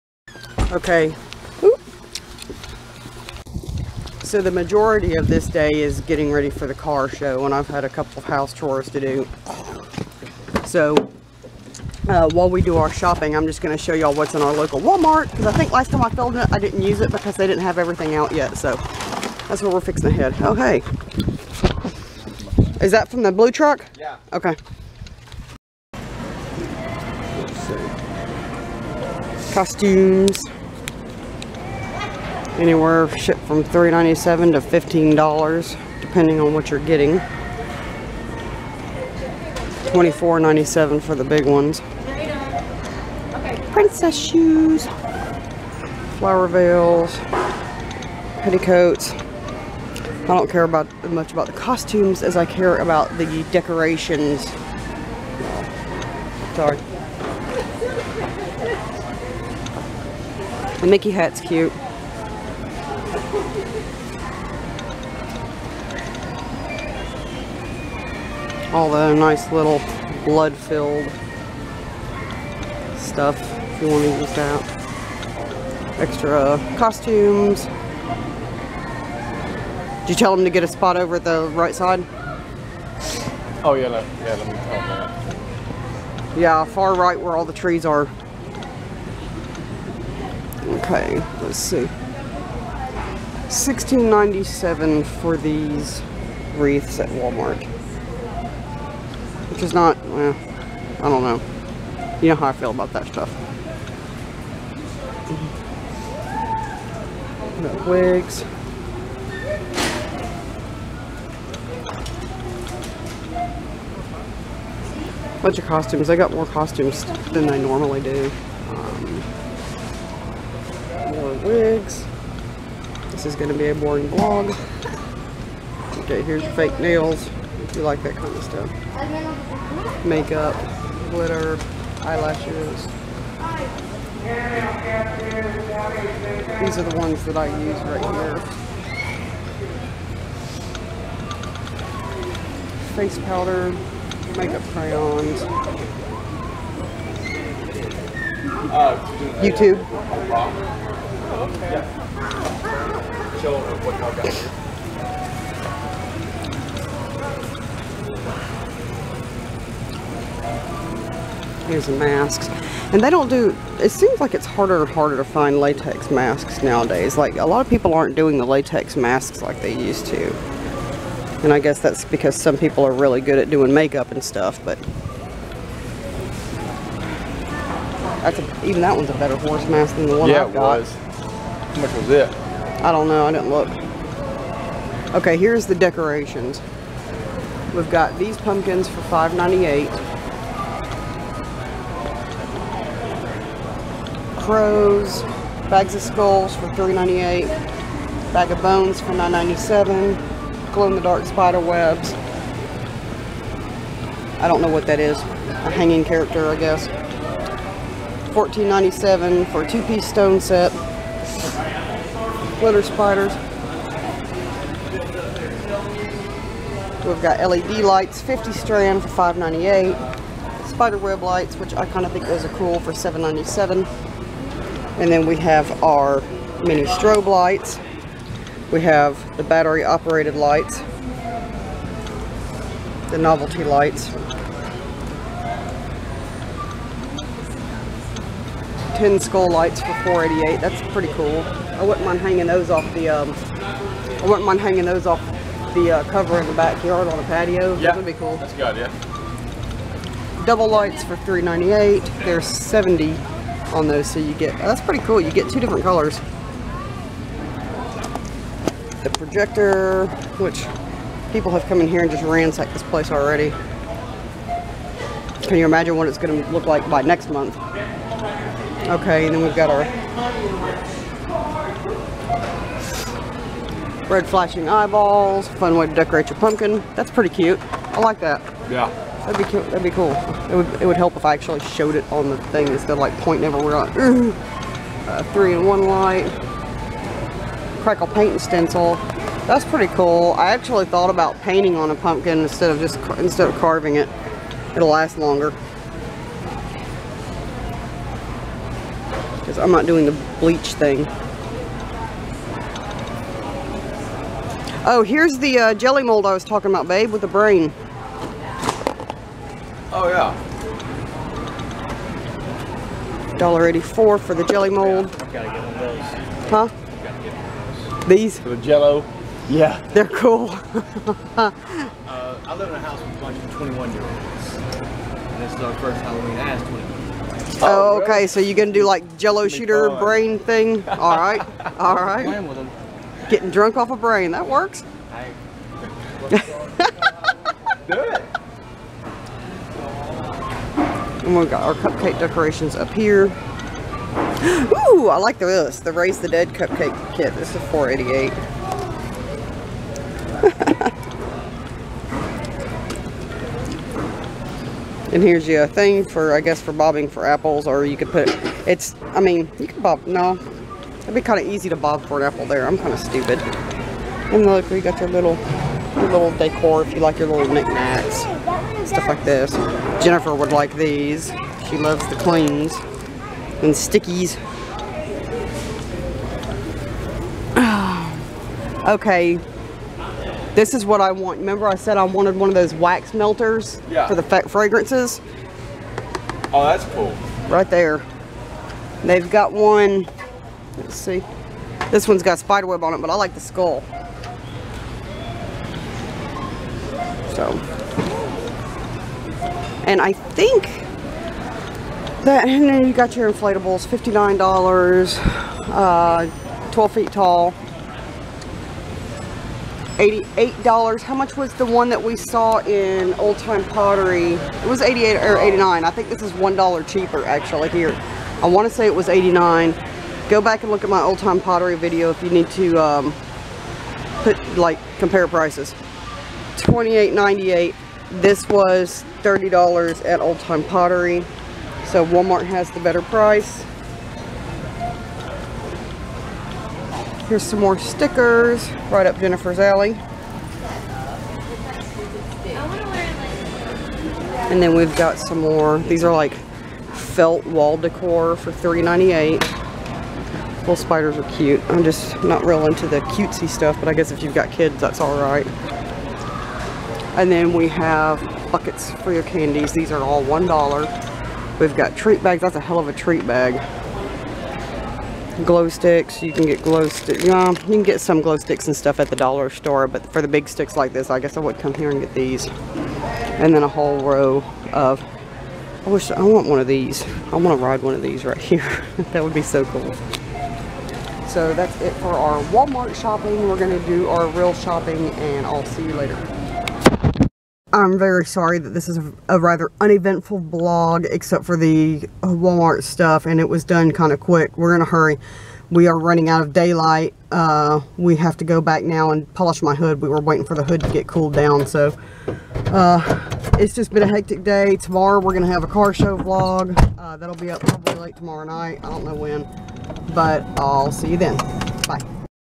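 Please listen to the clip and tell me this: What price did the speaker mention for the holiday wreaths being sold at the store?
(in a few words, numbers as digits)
$16.97.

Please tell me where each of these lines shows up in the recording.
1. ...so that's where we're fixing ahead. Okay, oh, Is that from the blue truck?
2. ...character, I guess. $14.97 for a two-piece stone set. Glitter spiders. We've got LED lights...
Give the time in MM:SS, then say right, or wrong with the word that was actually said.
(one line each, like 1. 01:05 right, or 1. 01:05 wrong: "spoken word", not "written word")
1. 00:18 right
2. 03:26 right.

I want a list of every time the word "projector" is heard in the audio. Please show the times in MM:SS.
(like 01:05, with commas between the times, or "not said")
04:19.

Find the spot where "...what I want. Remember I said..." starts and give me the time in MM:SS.
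06:20.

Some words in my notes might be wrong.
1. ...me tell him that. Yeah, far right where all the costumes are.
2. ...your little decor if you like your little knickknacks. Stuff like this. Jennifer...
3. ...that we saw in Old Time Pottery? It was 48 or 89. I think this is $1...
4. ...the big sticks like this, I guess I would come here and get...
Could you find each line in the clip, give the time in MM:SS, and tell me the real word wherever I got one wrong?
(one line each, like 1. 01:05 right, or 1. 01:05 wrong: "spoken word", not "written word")
1. 01:24 wrong: "trees", not "costumes"
2. 06:05 right
3. 06:51 wrong: "88", not "48"
4. 07:50 right.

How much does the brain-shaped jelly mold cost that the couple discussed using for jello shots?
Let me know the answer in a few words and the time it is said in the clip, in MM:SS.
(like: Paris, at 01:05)
$1.84, at 05:13.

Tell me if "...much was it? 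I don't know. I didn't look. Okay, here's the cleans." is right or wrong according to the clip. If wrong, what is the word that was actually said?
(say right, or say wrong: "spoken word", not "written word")
wrong: "decorations", not "cleans".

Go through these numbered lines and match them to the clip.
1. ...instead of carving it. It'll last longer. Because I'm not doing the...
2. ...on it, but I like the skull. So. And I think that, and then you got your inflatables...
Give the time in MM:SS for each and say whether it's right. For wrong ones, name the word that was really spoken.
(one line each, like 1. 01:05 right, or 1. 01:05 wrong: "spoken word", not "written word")
1. 04:53 right
2. 06:32 right.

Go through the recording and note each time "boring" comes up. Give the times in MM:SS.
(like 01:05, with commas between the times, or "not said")
02:03.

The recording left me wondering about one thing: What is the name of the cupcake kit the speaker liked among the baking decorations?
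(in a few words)
Raise the Dead.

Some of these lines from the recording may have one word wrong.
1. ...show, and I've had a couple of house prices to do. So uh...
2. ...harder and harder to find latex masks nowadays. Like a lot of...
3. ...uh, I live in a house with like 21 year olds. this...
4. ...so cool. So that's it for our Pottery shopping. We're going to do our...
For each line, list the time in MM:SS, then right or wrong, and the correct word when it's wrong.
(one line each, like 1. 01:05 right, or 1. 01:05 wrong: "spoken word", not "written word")
1. 00:07 wrong: "chores", not "prices"
2. 02:44 right
3. 05:20 right
4. 07:59 wrong: "Walmart", not "Pottery".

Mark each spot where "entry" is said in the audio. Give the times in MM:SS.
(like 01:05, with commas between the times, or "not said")
not said.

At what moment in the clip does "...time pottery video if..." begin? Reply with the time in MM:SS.
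07:01.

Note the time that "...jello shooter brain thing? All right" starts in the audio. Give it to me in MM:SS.
05:29.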